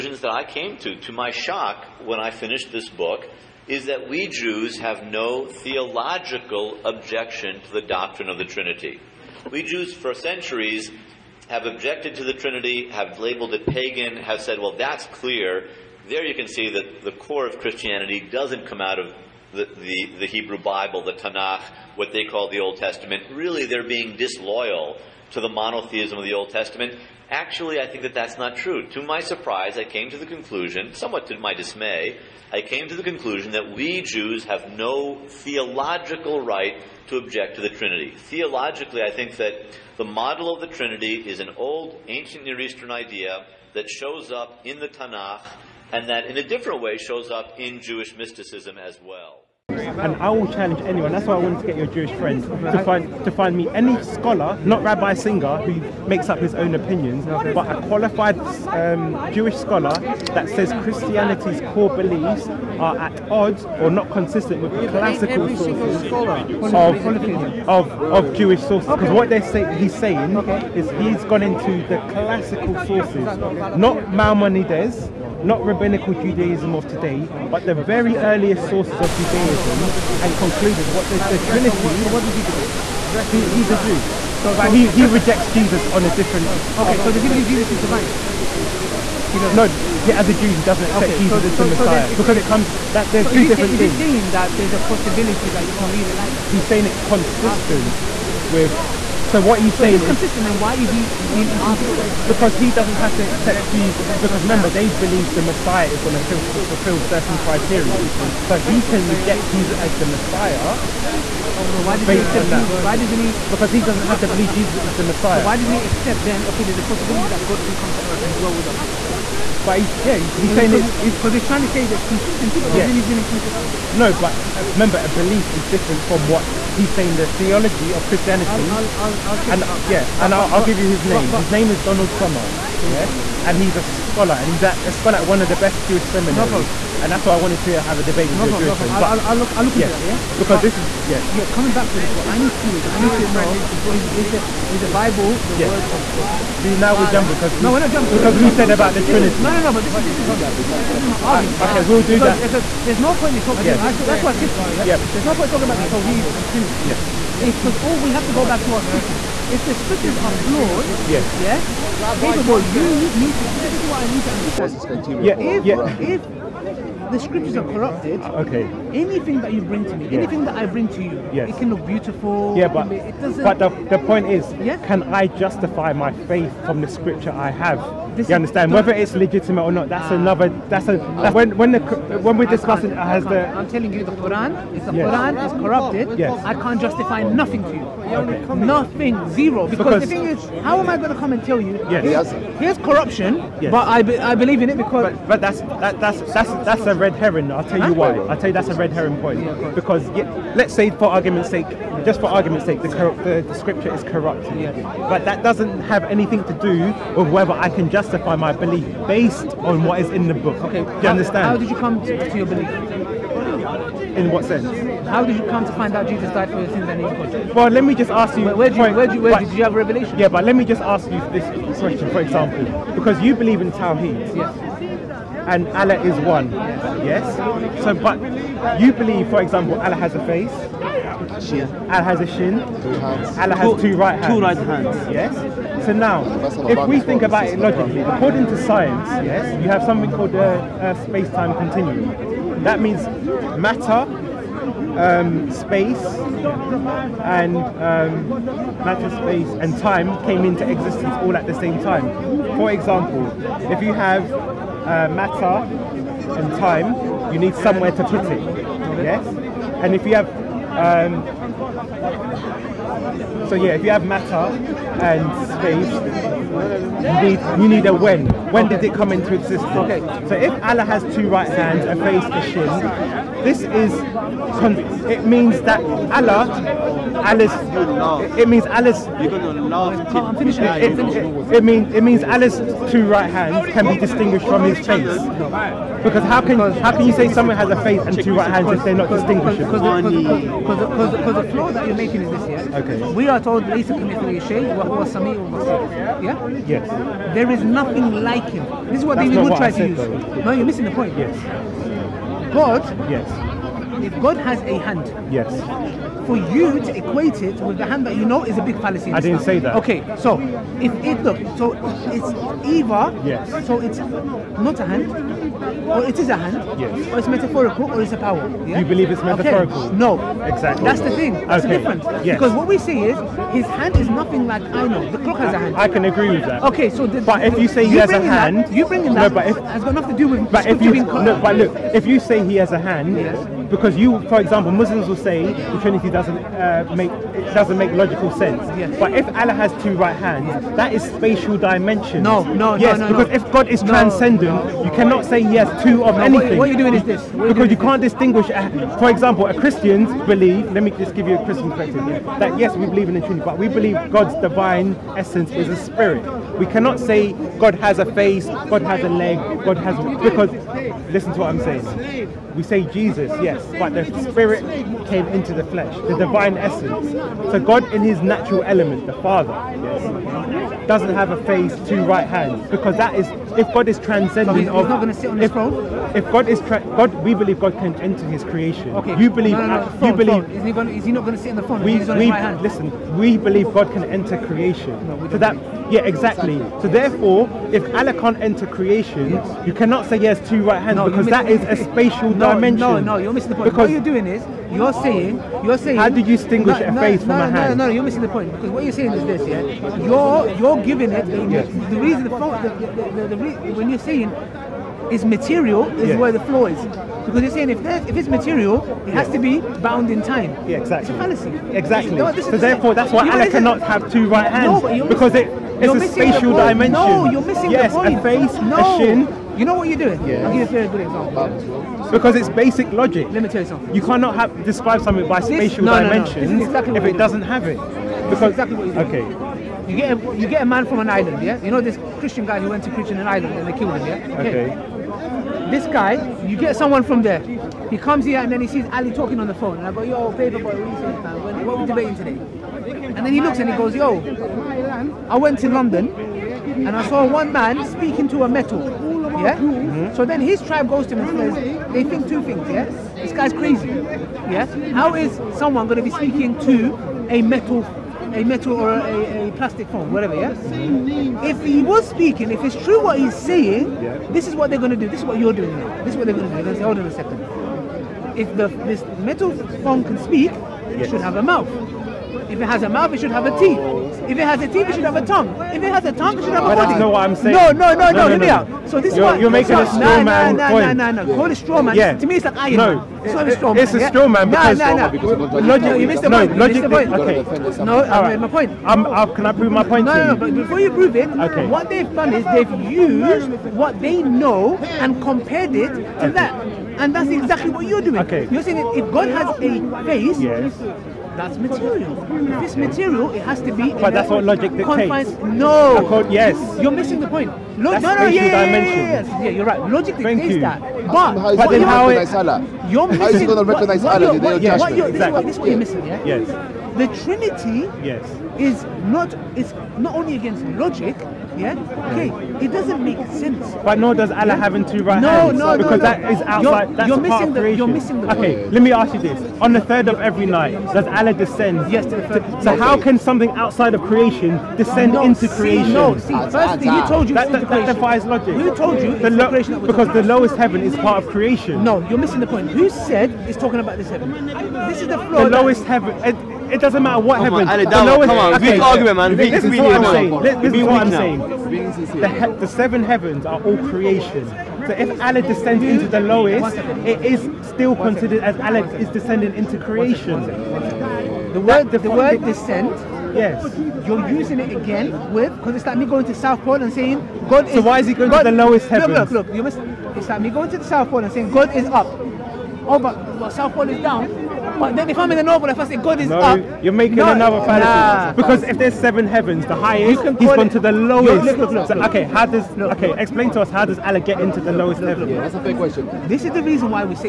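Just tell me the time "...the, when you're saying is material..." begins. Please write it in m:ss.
6:43.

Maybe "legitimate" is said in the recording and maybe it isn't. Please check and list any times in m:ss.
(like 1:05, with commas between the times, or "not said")
2:59.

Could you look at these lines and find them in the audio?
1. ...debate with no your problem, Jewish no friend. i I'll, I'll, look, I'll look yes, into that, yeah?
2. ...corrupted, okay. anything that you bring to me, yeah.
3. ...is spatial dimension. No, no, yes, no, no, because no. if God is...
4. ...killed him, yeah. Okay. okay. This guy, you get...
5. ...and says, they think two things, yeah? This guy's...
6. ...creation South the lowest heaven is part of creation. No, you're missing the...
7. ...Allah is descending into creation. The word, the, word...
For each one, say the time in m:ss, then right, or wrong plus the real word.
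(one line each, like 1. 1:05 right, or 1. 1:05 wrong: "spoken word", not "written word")
1. 2:18 right
2. 2:47 right
3. 5:40 right
4. 7:13 right
5. 7:31 right
6. 8:59 wrong: "Because", not "South"
7. 9:18 right.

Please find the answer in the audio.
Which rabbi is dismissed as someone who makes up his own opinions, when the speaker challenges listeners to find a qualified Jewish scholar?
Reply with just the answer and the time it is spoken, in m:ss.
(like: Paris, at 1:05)
Rabbi Singer, at 0:54.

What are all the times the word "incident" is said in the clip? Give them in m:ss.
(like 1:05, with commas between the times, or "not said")
not said.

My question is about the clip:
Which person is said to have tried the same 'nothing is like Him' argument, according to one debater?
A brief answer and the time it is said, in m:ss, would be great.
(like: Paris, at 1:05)
David Wood, at 4:59.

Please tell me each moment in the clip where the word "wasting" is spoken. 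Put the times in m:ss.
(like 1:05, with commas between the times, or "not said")
not said.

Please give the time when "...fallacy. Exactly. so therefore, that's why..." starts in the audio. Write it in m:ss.
6:51.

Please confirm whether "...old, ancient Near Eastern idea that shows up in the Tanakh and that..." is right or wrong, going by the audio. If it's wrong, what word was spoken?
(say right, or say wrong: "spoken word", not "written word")
right.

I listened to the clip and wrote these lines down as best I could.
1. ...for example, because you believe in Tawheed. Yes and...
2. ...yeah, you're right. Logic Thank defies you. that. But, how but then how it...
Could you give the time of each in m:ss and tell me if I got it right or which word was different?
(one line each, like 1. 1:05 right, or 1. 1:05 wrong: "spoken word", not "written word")
1. 3:42 right
2. 8:29 wrong: "dictates", not "defies".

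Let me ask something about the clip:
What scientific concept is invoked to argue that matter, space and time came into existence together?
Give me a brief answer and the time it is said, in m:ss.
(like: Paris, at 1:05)
Space-time continuum, at 4:01.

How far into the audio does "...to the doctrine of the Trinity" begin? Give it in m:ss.
0:07.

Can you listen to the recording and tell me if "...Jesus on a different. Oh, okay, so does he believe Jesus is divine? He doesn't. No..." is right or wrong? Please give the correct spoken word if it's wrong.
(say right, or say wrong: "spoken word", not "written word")
right.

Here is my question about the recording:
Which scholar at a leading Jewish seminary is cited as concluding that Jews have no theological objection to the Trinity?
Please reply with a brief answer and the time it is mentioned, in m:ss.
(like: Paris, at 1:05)
Donald Sommer, at 2:11.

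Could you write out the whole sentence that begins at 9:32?
Oh, but well, South Pole is down.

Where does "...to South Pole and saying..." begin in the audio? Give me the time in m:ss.
9:26.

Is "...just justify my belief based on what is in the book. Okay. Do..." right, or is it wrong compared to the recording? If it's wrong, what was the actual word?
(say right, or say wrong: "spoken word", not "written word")
right.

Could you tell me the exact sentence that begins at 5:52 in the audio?
Yeah, that yes, we believe in the Trinity, but we believe God's divine essence is a spirit.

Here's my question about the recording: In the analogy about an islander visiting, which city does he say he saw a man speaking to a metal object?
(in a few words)
London.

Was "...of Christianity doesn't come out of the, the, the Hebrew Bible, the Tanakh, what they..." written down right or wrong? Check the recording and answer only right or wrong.
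right.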